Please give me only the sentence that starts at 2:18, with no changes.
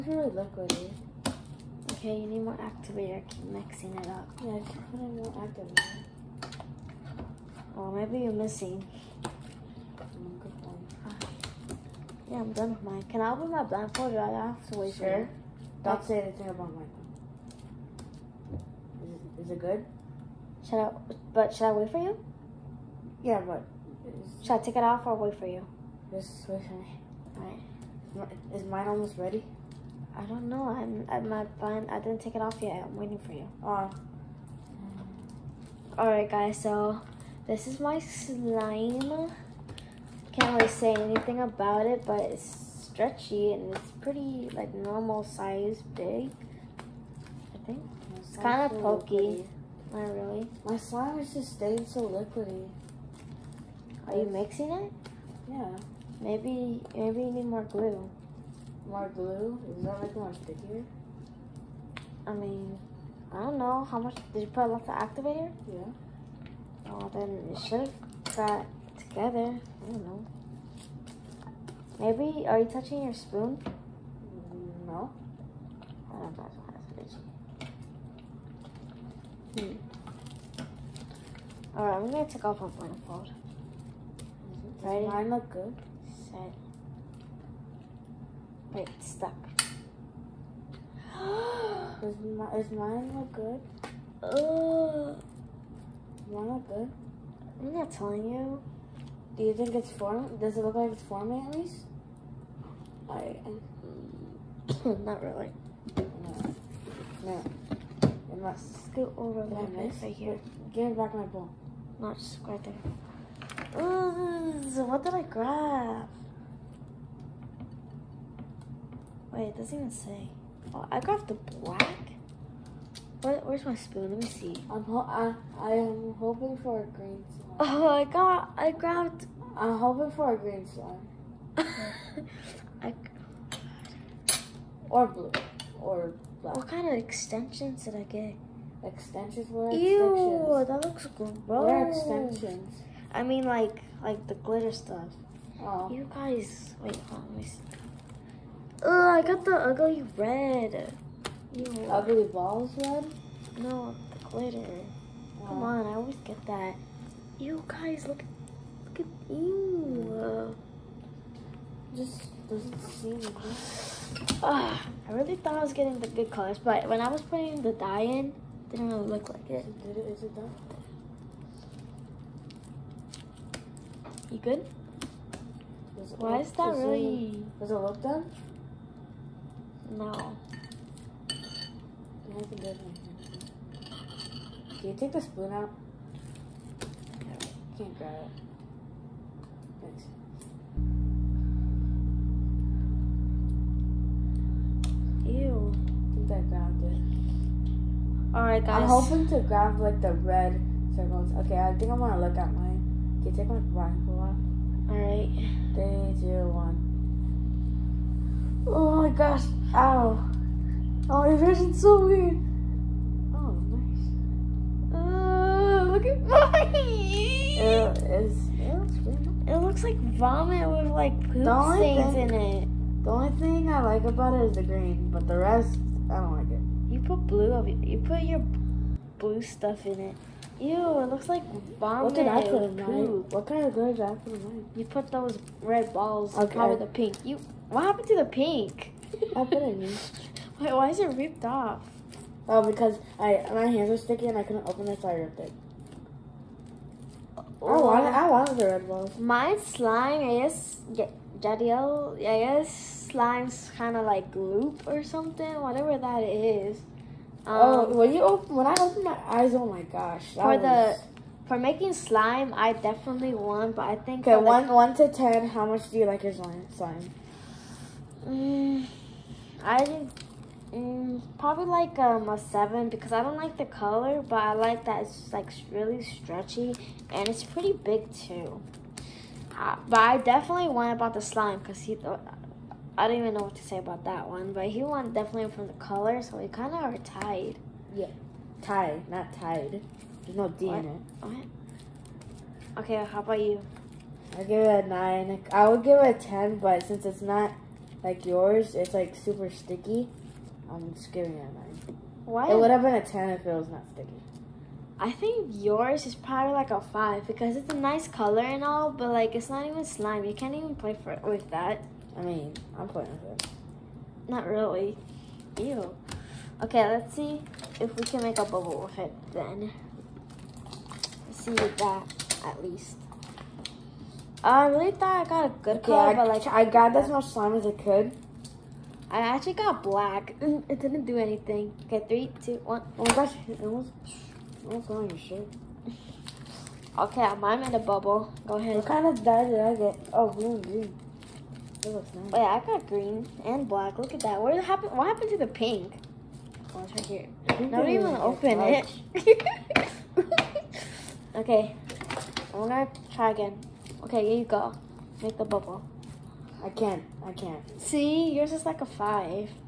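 Extensions were Ew, that looks gross.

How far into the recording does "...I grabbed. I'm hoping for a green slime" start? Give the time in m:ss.
2:08.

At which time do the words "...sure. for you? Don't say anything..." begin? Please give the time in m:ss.
0:14.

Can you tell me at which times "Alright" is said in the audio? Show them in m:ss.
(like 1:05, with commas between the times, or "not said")
0:27, 0:35, 1:21, 3:18, 3:24.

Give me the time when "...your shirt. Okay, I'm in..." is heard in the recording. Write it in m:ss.
5:35.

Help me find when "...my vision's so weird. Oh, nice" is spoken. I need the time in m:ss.
3:31.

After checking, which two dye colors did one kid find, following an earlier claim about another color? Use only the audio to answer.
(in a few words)
Green and black.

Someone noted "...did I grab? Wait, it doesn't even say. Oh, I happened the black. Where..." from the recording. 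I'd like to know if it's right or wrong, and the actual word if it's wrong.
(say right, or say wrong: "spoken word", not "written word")
wrong: "grabbed", not "happened".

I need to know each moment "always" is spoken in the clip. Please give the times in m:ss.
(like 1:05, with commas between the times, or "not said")
2:35.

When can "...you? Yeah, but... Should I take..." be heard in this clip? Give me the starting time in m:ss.
0:22.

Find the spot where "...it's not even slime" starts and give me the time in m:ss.
5:09.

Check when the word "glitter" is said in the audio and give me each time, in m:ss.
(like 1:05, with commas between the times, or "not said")
2:24, 2:34, 3:53.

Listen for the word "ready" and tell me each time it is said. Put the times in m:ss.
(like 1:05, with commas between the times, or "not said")
0:29, 1:24.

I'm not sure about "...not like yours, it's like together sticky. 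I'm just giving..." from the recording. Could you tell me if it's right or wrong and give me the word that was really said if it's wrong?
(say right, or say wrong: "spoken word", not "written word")
wrong: "super", not "together".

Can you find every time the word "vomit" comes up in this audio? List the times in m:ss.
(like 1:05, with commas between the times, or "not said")
3:40, 3:51.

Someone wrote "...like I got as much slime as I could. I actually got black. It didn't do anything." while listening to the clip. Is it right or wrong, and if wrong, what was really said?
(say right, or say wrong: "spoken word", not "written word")
right.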